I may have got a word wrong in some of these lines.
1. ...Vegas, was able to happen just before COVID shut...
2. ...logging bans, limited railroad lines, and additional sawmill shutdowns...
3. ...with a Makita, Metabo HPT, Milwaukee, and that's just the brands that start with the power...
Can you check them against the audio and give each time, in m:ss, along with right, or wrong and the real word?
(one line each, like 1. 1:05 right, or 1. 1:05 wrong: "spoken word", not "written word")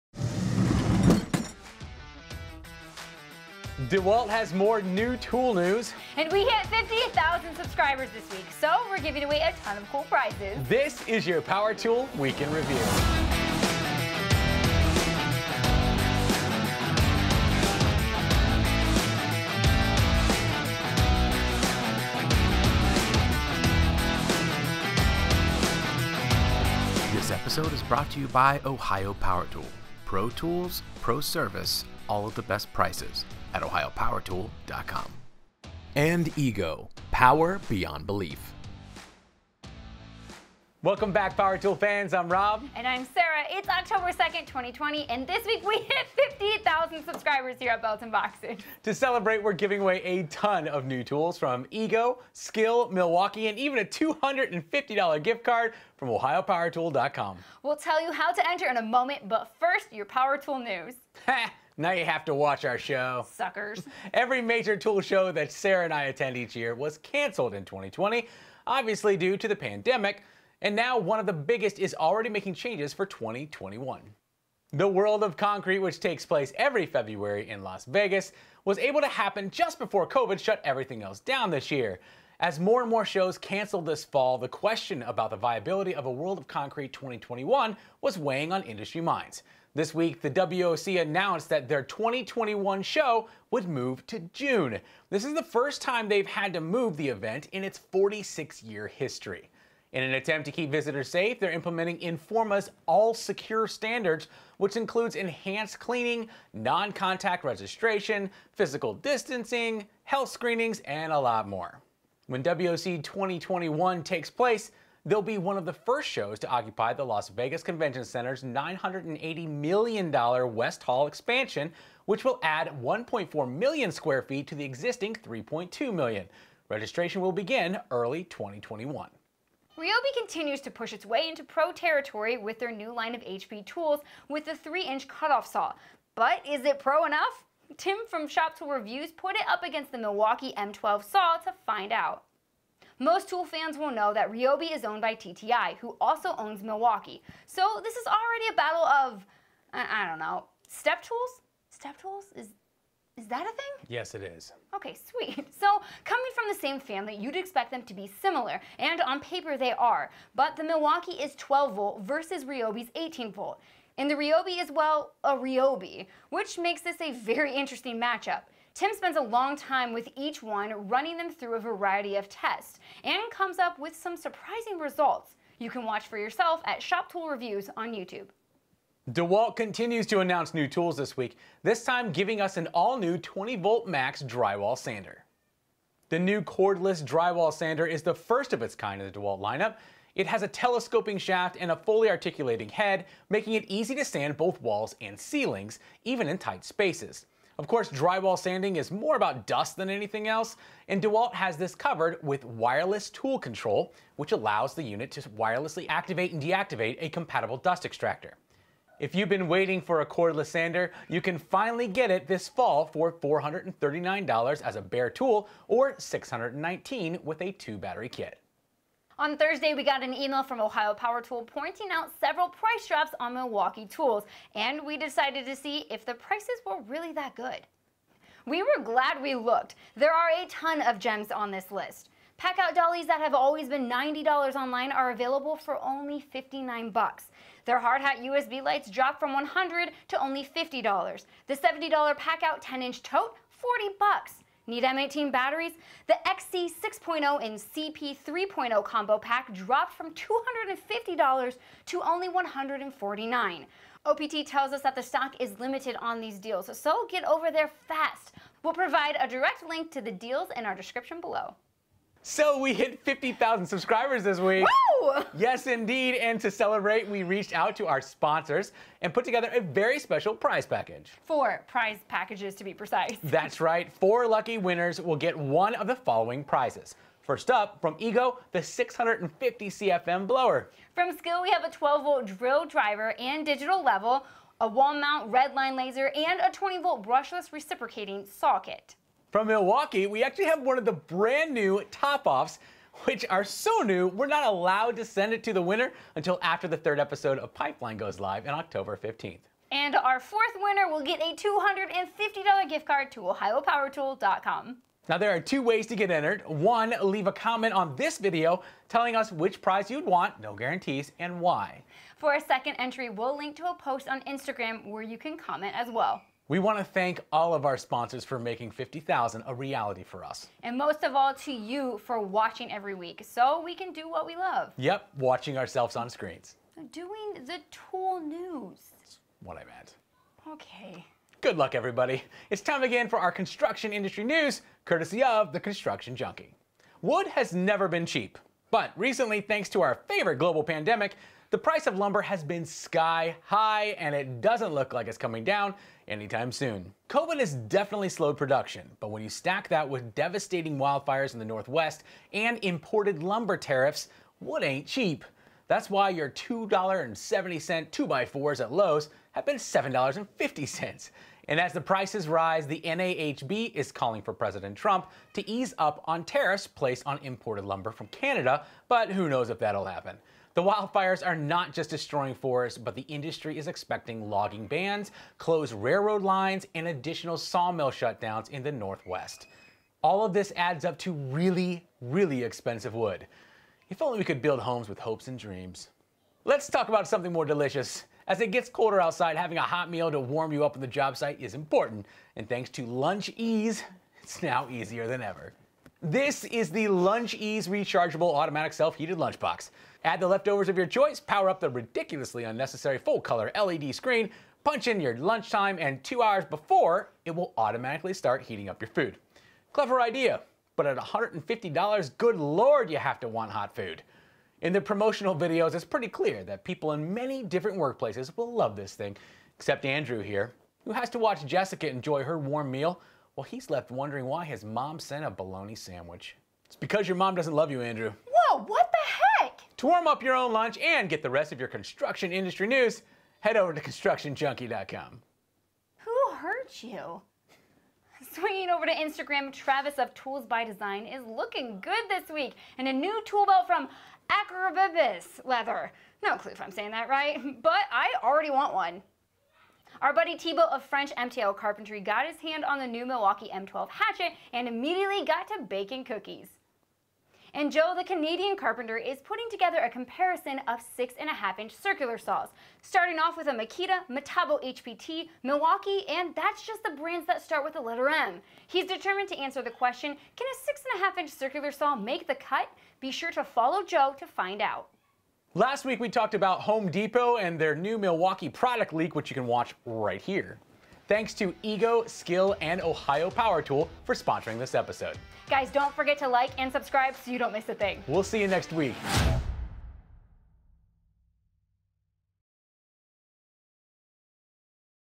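1. 1:17 right
2. 6:14 wrong: "closed", not "limited"
3. 7:43 wrong: "letter", not "power".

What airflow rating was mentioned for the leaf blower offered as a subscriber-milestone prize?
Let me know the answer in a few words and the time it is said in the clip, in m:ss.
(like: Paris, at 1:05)
650 CFM, at 4:38.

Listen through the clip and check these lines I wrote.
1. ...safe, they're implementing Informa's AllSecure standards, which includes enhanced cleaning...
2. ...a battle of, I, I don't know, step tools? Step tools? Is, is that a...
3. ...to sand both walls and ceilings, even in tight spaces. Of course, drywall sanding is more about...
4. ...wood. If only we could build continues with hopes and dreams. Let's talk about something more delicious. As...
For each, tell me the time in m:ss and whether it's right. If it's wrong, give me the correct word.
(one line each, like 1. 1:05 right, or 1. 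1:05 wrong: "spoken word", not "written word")
1. 1:41 right
2. 2:28 right
3. 3:13 right
4. 6:22 wrong: "homes", not "continues".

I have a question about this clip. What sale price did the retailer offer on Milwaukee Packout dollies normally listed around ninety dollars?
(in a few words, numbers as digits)
$59.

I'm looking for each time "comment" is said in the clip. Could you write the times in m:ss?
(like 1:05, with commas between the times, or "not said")
5:07, 5:15.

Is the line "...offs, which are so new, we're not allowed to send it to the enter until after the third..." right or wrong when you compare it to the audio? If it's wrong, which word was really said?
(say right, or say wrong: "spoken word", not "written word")
wrong: "winner", not "enter".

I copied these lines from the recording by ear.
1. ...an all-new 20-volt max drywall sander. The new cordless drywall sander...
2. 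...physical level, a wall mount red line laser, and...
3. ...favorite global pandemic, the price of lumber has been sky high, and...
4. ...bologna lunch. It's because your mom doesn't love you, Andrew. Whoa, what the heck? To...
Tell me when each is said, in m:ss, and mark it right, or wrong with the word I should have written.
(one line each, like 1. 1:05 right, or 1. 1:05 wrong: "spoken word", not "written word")
1. 3:02 right
2. 4:43 wrong: "digital", not "physical"
3. 5:40 right
4. 7:05 wrong: "sandwich", not "lunch".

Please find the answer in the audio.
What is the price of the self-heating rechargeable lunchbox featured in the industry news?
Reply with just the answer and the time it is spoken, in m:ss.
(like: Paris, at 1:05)
$150, at 6:50.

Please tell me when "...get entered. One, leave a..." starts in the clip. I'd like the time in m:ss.
5:05.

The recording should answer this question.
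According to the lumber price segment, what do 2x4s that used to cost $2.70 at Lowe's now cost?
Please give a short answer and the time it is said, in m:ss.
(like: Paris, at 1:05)
$7.50, at 5:59.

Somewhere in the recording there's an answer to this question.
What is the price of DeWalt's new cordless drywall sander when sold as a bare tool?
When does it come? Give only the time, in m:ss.
3:33.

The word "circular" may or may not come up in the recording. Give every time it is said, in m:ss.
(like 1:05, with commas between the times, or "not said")
7:41, 7:51.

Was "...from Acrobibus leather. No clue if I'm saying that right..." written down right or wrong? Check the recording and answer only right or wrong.
right.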